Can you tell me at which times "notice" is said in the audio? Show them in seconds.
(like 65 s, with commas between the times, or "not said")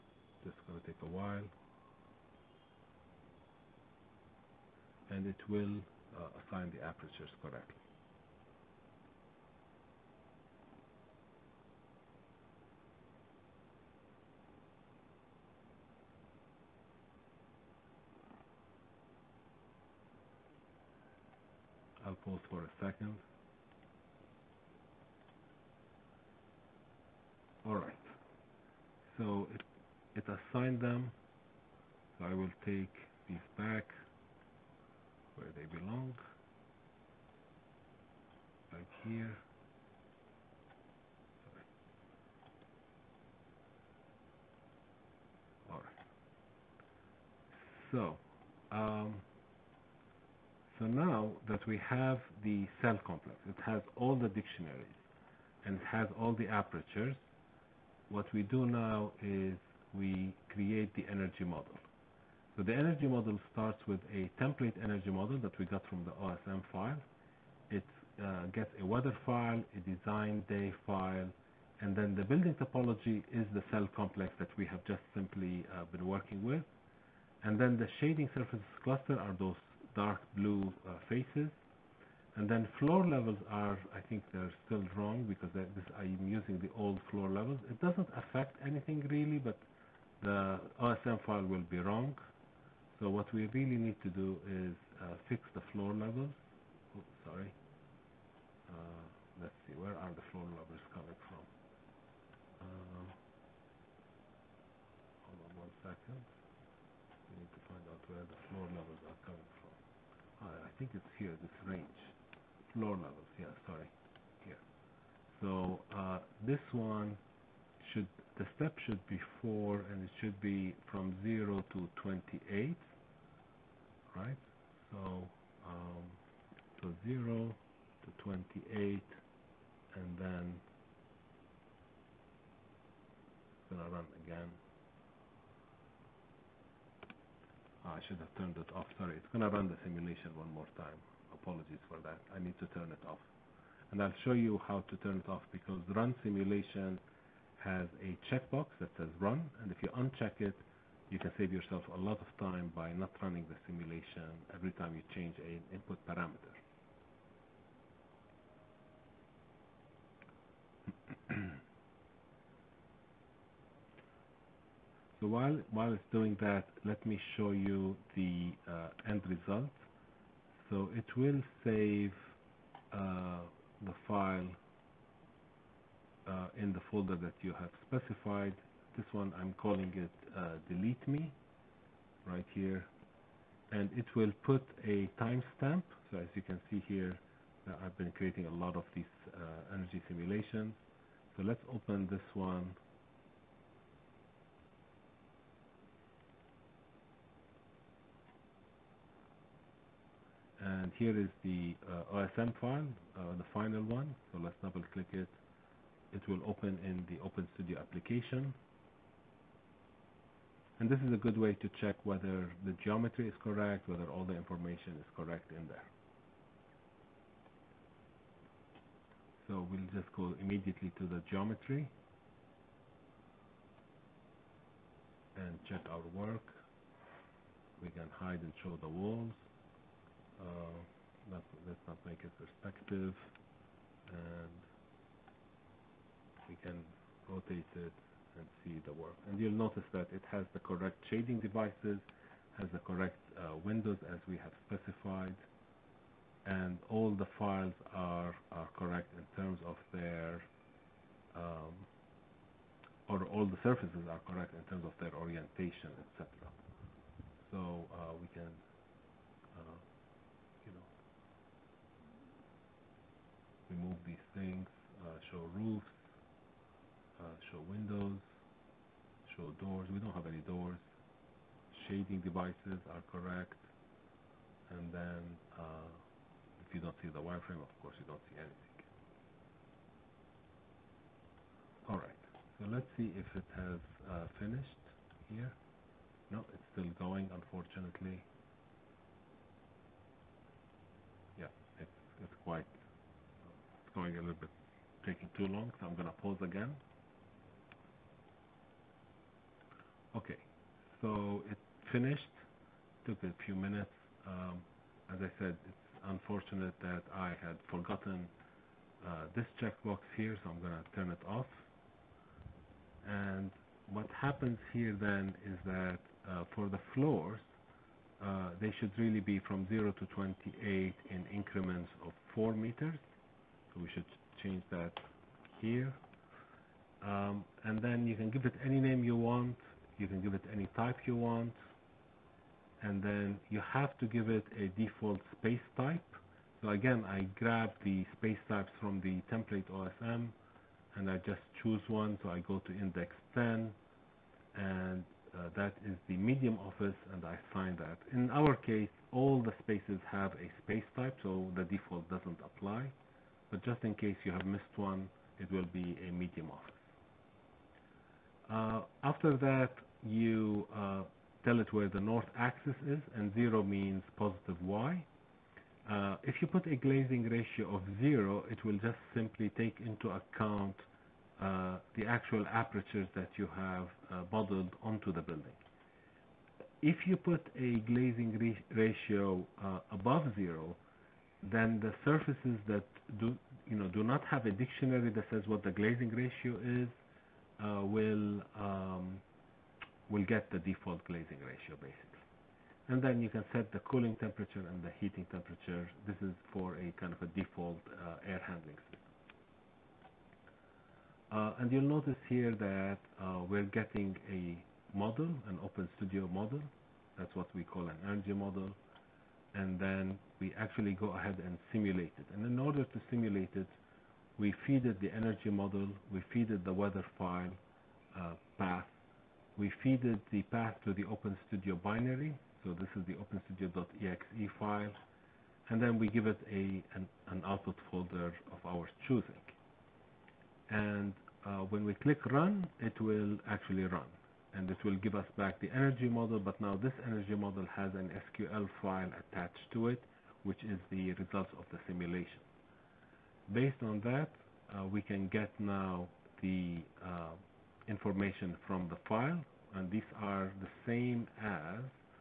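239 s, 401 s.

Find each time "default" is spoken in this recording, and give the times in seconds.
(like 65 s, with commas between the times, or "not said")
334 s, 351 s, 390 s, 397 s.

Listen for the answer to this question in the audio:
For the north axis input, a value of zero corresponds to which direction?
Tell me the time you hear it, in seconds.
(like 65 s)
364 s.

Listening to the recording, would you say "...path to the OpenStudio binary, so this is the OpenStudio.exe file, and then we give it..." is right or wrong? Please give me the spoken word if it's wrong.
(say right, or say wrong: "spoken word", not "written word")
right.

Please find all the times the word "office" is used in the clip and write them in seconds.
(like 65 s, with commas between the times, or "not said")
346 s, 356 s.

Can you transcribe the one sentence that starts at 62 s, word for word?
So the energy model starts with a template energy model that we got from the OSM file.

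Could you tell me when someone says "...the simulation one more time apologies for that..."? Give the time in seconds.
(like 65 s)
139 s.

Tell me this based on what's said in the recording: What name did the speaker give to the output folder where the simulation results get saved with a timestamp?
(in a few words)
delete me.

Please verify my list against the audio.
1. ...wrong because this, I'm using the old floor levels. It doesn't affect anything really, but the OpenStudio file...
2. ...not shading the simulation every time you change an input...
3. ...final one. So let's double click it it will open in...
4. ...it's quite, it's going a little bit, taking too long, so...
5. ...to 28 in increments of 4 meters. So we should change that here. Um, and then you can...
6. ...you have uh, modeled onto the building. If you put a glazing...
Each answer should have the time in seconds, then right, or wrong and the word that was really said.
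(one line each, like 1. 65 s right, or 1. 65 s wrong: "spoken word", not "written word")
1. 84 s wrong: "OSM", not "OpenStudio"
2. 152 s wrong: "running", not "shading"
3. 203 s right
4. 292 s right
5. 319 s right
6. 373 s right.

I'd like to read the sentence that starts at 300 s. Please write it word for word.
Okay, so it finished, took a few minutes.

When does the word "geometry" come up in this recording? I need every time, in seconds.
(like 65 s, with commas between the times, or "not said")
212 s, 221 s.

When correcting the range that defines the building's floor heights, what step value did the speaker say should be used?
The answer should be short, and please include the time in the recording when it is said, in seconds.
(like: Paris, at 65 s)
4, at 118 s.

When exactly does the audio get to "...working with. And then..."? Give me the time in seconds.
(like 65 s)
76 s.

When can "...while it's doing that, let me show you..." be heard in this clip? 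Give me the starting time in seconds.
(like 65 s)
165 s.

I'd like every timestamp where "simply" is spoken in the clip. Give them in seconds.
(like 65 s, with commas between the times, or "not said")
75 s, 369 s.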